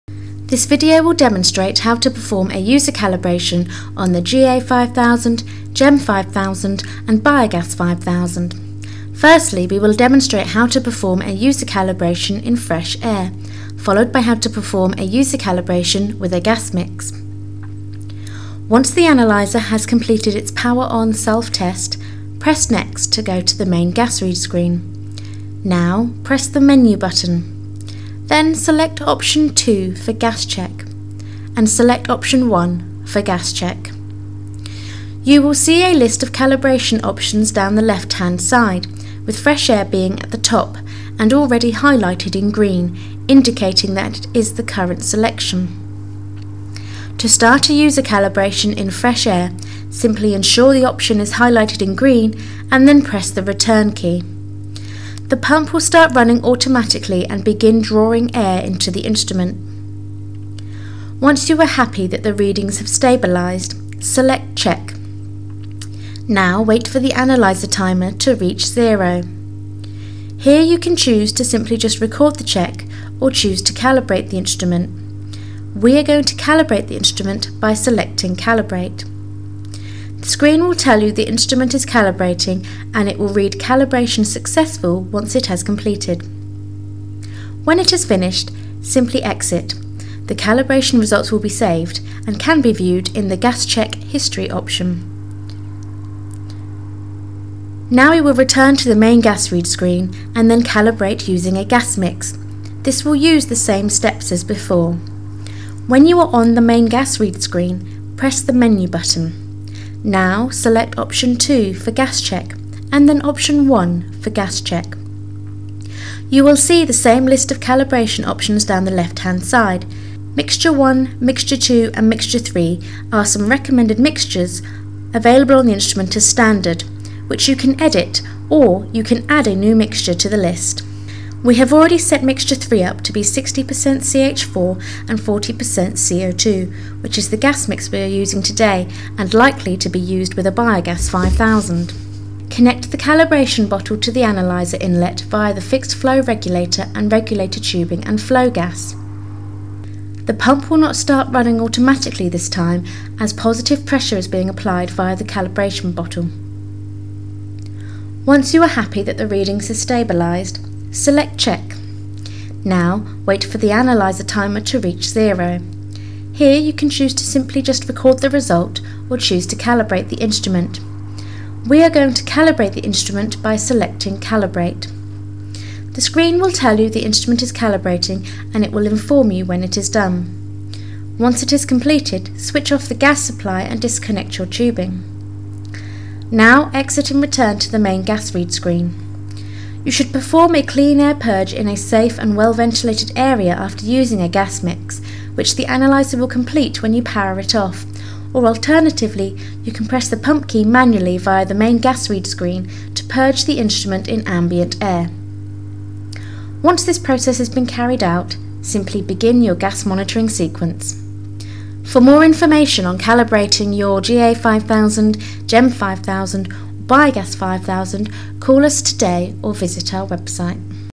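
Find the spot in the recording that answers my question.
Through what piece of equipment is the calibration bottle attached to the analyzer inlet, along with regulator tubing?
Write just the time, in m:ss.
2:25.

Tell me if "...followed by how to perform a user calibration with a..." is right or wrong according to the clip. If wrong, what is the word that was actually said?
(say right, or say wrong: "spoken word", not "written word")
right.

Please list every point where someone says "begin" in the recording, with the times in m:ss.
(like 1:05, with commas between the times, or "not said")
0:57, 3:29.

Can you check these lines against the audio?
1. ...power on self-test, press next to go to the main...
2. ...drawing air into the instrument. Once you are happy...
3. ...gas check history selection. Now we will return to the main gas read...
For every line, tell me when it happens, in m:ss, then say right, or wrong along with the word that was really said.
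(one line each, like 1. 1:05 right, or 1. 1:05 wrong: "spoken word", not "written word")
1. 0:20 right
2. 0:57 right
3. 1:33 wrong: "option", not "selection".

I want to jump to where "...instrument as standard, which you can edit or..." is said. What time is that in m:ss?
2:05.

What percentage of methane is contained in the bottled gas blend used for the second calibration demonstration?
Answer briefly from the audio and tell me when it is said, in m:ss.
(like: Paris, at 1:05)
60%, at 2:13.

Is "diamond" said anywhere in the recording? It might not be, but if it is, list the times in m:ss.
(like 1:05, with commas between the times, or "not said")
not said.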